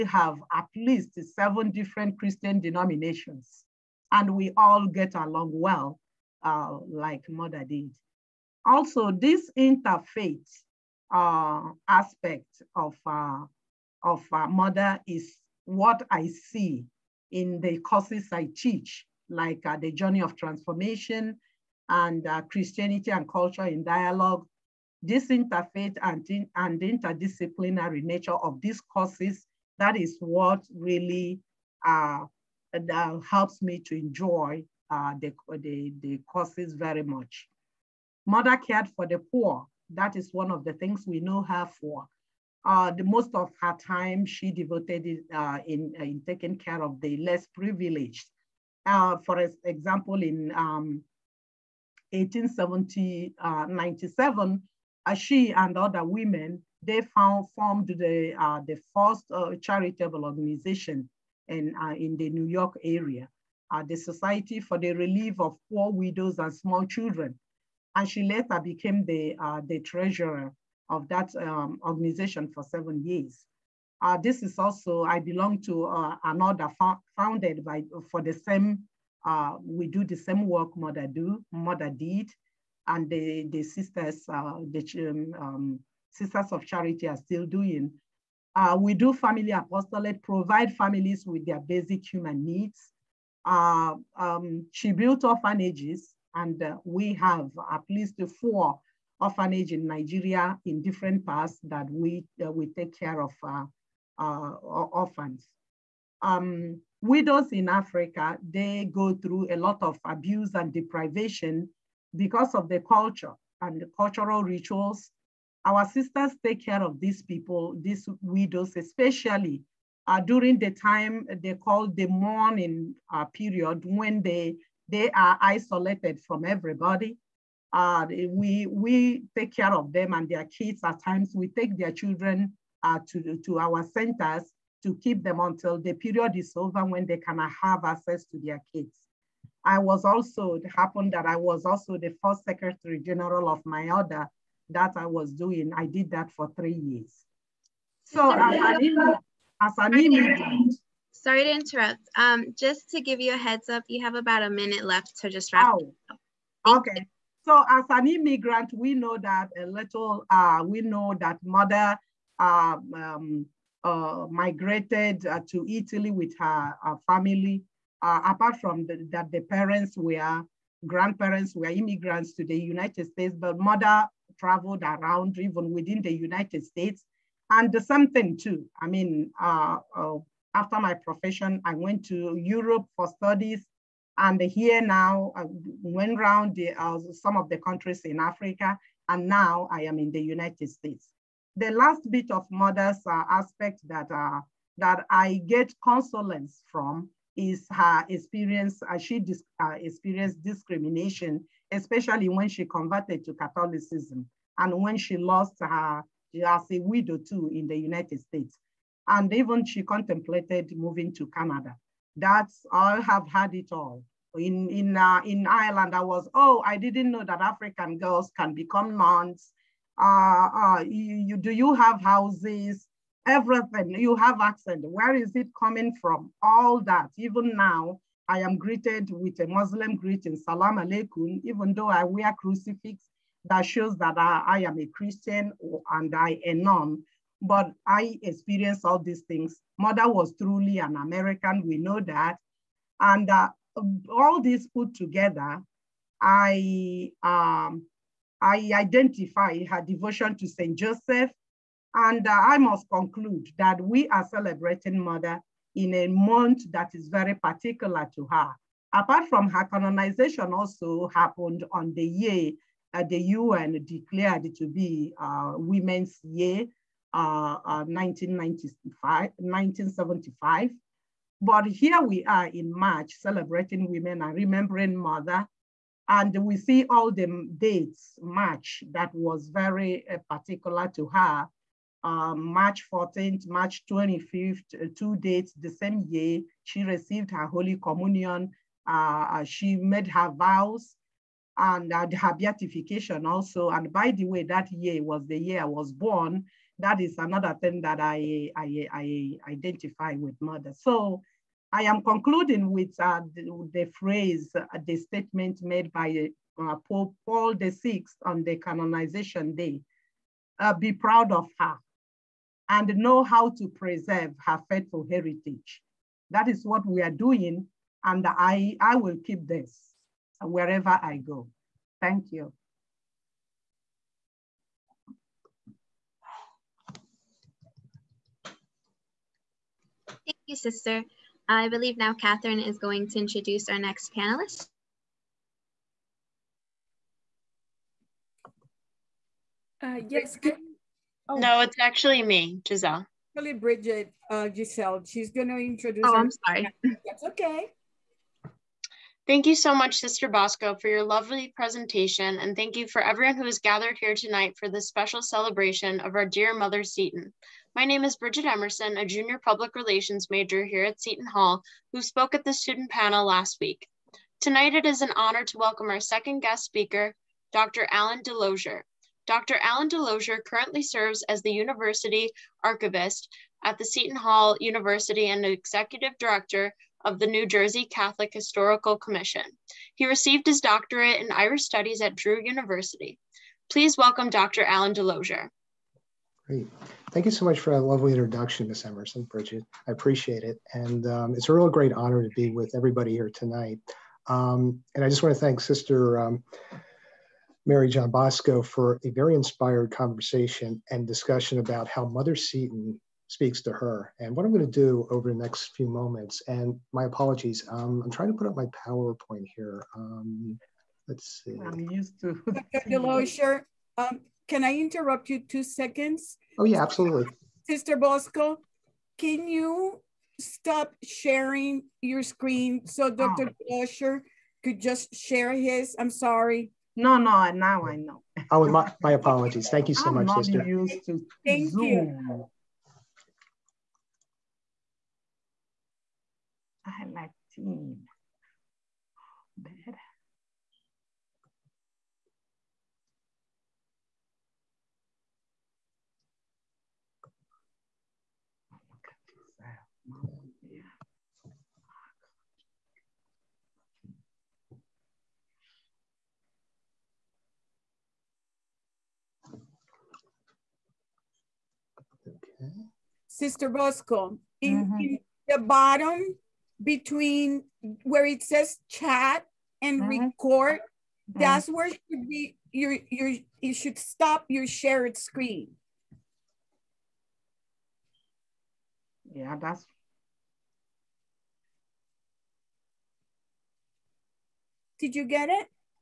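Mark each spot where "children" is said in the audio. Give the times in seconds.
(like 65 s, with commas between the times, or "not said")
66 s, 131 s.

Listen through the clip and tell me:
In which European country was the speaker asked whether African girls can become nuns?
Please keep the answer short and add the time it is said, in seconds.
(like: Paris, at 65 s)
Ireland, at 215 s.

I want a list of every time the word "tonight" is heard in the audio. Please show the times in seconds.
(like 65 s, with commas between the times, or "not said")
354 s, 364 s, 393 s.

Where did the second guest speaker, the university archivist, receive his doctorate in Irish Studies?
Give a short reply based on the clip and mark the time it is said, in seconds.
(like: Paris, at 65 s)
Drew University, at 382 s.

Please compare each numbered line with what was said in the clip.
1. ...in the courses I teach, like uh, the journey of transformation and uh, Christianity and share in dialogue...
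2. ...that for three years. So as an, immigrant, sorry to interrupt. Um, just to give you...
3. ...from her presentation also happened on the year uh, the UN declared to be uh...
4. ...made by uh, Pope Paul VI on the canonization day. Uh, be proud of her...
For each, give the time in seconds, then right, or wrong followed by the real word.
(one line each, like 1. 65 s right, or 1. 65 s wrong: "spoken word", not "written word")
1. 17 s wrong: "culture", not "share"
2. 146 s right
3. 259 s wrong: "canonization", not "presentation"
4. 305 s right.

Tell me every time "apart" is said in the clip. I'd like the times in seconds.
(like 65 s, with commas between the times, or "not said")
168 s, 258 s.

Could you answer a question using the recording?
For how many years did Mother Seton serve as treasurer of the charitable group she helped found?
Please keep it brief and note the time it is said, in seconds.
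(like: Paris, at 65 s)
7, at 72 s.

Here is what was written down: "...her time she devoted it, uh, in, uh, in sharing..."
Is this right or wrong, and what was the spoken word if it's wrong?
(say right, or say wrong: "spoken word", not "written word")
wrong: "taking", not "sharing".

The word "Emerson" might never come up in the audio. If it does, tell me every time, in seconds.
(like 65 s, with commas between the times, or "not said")
358 s, 388 s.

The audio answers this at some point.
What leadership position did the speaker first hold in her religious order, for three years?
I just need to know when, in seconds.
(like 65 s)
142 s.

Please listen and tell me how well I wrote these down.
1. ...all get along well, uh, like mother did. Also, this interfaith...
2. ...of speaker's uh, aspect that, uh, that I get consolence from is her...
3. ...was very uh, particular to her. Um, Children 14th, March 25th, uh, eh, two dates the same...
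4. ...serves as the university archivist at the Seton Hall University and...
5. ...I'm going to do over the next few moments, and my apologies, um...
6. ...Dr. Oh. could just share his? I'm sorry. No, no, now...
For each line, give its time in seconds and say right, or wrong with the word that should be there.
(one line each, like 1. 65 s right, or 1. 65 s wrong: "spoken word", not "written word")
1. 4 s right
2. 192 s wrong: "mother", not "speaker"
3. 279 s wrong: "March", not "Children"
4. 370 s right
5. 404 s right
6. 423 s right.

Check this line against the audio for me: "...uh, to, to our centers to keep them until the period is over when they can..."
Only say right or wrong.
right.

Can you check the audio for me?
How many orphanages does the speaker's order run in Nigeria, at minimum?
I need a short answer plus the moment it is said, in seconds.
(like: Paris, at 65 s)
4, at 98 s.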